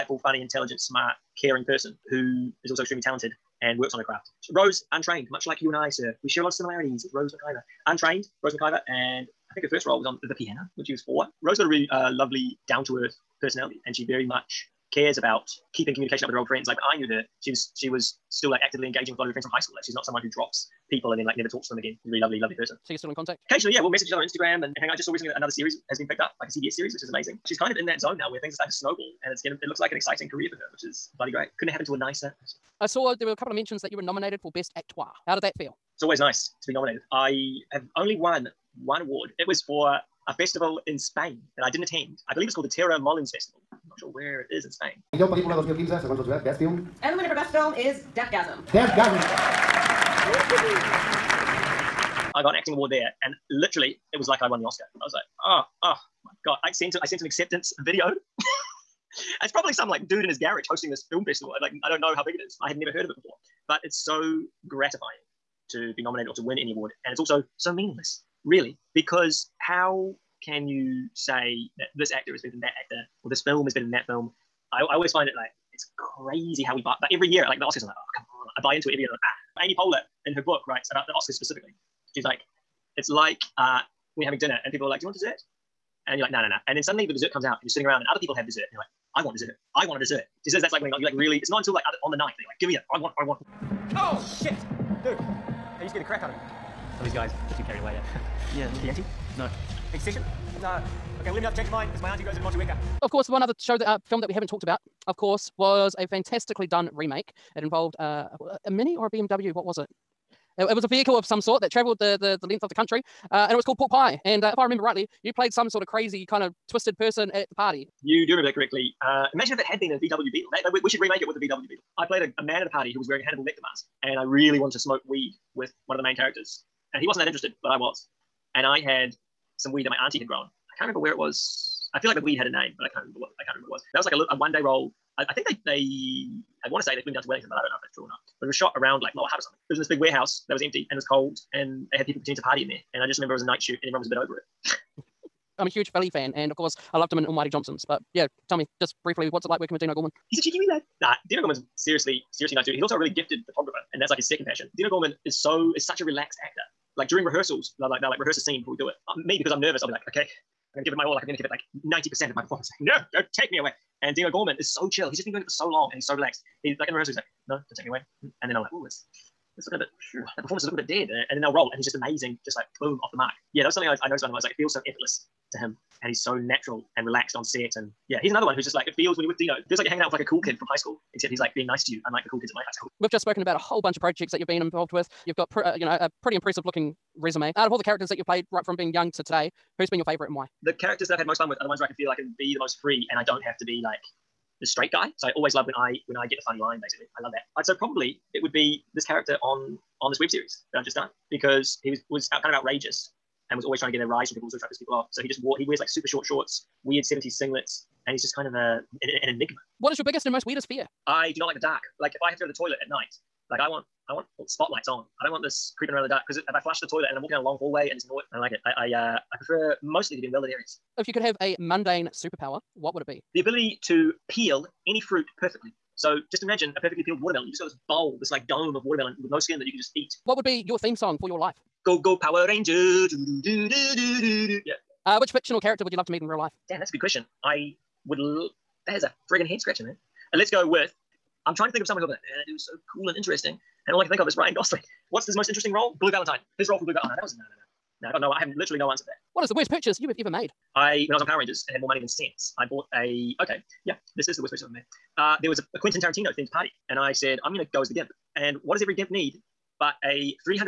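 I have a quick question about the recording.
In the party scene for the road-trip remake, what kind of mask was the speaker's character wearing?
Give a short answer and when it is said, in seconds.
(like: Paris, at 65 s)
Hannibal Lecter mask, at 123 s.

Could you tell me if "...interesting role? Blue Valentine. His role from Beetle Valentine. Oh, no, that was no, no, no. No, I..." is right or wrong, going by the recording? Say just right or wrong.
wrong.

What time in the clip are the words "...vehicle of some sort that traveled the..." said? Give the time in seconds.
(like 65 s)
110 s.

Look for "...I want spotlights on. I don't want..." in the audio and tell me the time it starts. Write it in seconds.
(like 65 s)
214 s.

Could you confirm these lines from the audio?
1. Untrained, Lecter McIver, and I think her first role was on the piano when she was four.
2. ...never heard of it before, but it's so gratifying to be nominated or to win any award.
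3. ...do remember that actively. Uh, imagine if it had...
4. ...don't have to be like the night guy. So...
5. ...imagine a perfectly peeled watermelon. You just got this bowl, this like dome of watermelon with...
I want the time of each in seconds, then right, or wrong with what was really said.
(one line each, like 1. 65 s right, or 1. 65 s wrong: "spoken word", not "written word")
1. 7 s wrong: "Rose", not "Lecter"
2. 62 s right
3. 118 s wrong: "correctly", not "actively"
4. 193 s wrong: "straight", not "night"
5. 226 s right.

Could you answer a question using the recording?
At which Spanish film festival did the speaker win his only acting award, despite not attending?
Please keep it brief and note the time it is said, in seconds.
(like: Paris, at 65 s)
Terror Molins Festival, at 42 s.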